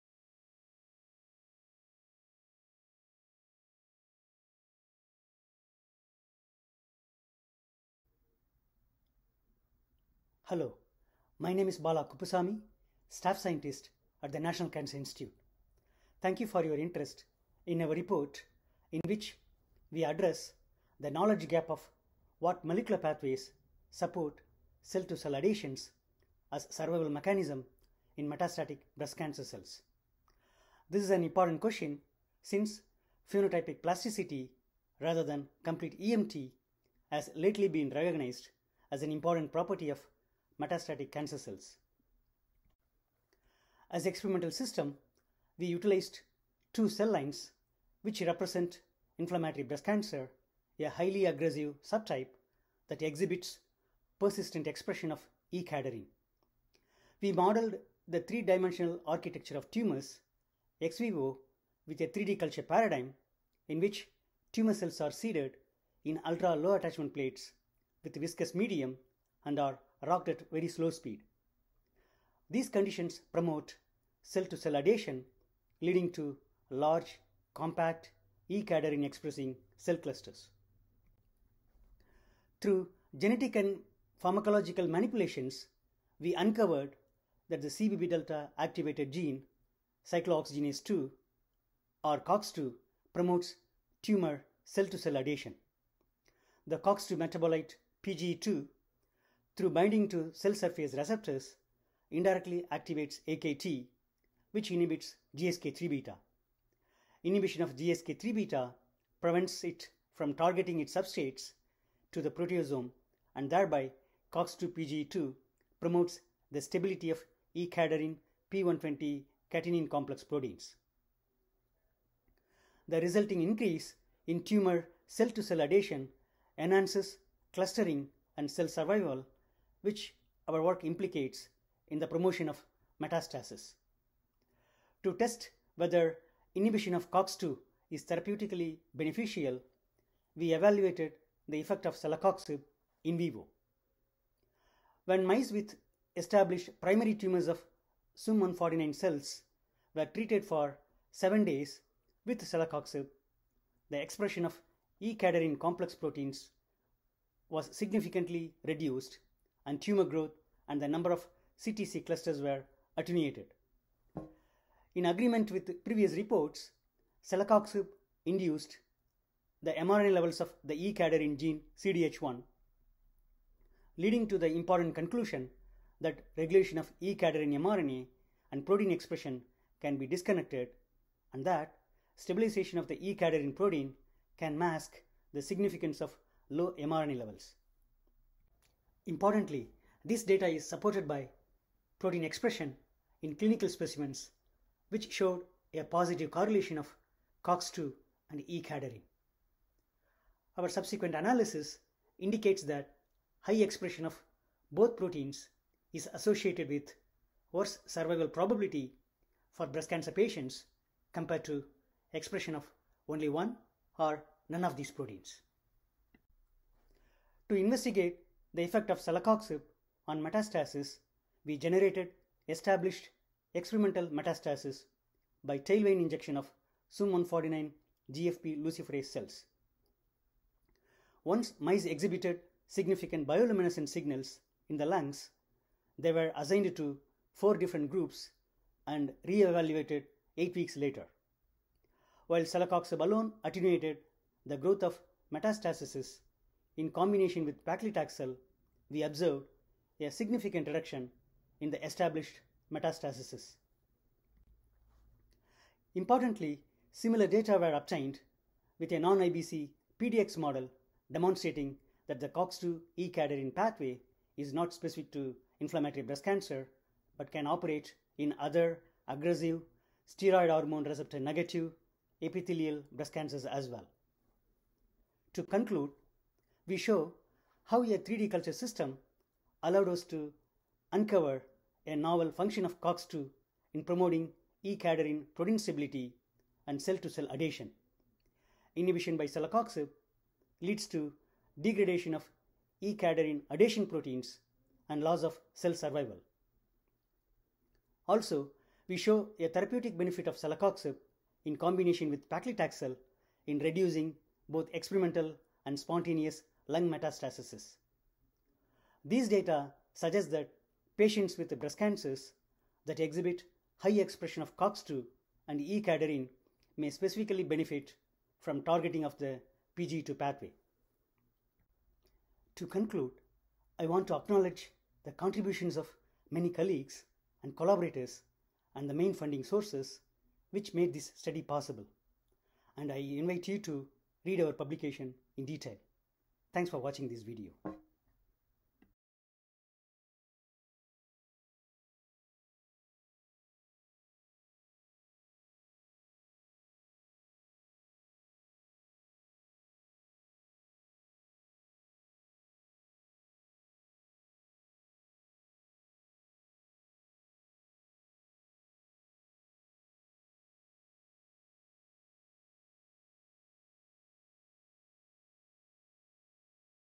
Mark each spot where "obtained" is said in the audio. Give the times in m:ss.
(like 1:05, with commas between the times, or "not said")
4:17.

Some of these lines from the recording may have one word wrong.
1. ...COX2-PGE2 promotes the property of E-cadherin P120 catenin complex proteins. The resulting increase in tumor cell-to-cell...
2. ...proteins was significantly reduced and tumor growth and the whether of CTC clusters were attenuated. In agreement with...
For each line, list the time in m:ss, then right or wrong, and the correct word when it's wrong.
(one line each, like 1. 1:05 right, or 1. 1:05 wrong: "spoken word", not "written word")
1. 1:54 wrong: "stability", not "property"
2. 2:35 wrong: "number", not "whether".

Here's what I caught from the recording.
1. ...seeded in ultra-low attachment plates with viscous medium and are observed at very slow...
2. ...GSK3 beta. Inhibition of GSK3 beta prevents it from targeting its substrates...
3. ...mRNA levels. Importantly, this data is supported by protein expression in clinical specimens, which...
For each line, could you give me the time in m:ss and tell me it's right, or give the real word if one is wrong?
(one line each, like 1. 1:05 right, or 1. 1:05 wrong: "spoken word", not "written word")
1. 1:05 wrong: "rocked", not "observed"
2. 1:45 right
3. 3:06 right.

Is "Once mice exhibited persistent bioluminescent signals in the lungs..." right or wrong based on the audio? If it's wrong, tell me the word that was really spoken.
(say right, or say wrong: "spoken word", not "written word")
wrong: "significant", not "persistent".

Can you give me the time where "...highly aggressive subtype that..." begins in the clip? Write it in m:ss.
0:50.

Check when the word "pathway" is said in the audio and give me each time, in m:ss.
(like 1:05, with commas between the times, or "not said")
0:22, 4:23, 5:20.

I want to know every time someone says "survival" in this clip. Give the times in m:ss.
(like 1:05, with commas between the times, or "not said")
0:26, 2:08, 3:27, 4:55.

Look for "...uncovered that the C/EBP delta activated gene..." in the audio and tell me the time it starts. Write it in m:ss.
1:26.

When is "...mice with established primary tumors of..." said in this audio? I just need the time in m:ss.
2:25.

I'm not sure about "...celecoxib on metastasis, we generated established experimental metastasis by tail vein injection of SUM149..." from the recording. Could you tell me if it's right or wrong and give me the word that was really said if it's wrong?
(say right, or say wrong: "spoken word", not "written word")
right.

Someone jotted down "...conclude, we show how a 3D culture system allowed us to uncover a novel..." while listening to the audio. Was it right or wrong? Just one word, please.
right.